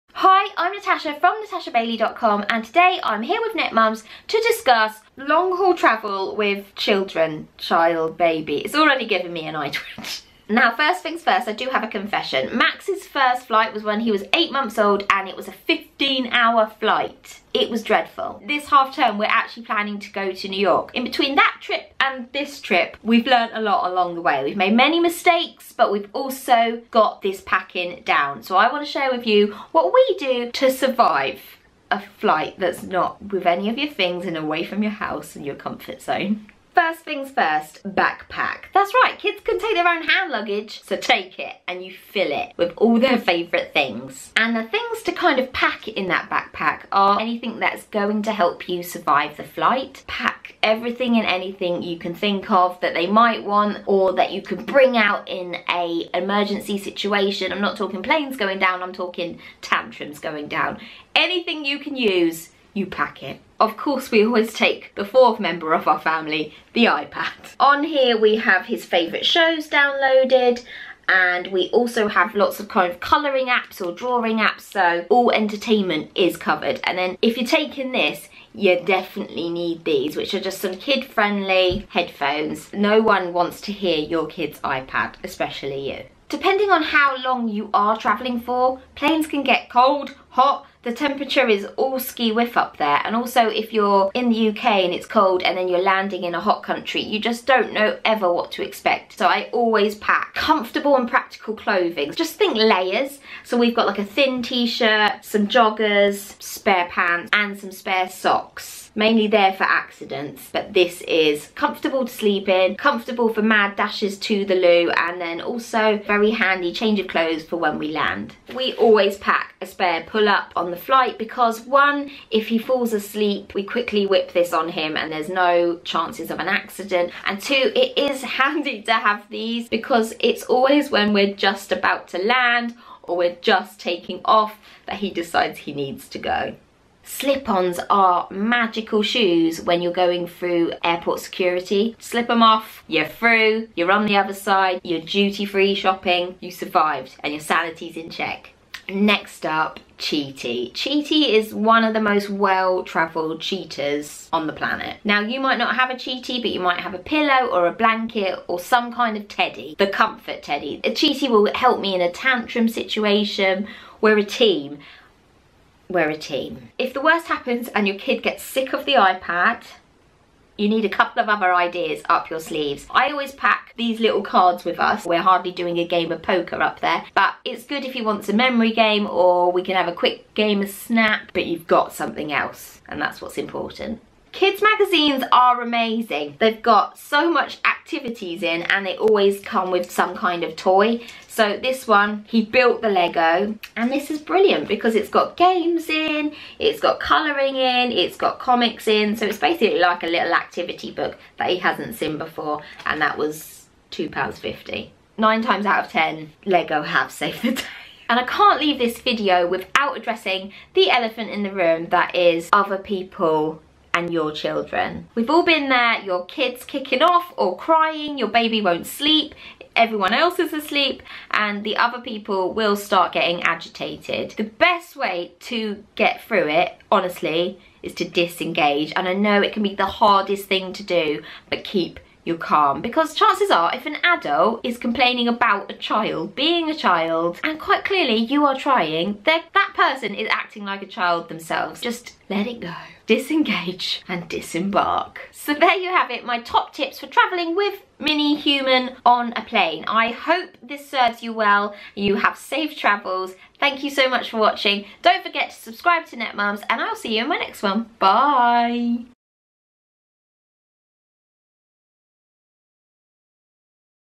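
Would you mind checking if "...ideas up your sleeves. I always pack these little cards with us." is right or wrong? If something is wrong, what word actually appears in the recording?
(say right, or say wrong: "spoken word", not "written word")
right.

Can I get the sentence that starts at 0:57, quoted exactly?
I'm not talking planes going down, I'm talking tantrums going down.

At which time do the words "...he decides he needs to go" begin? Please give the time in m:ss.
2:14.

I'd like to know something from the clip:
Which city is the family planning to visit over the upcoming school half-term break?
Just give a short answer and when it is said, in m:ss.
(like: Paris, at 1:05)
New York, at 0:20.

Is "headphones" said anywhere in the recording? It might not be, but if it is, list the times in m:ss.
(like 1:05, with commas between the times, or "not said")
1:21.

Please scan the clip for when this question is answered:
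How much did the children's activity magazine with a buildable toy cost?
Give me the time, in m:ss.
3:23.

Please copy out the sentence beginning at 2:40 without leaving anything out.
A cheaty will help me in a tantrum situation.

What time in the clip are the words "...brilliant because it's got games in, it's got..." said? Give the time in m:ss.
3:14.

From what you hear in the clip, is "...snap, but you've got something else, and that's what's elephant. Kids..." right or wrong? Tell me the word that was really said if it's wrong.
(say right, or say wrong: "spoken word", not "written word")
wrong: "important", not "elephant".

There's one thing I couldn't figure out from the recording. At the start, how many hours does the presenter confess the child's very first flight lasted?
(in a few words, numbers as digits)
15.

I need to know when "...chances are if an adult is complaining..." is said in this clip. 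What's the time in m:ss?
3:53.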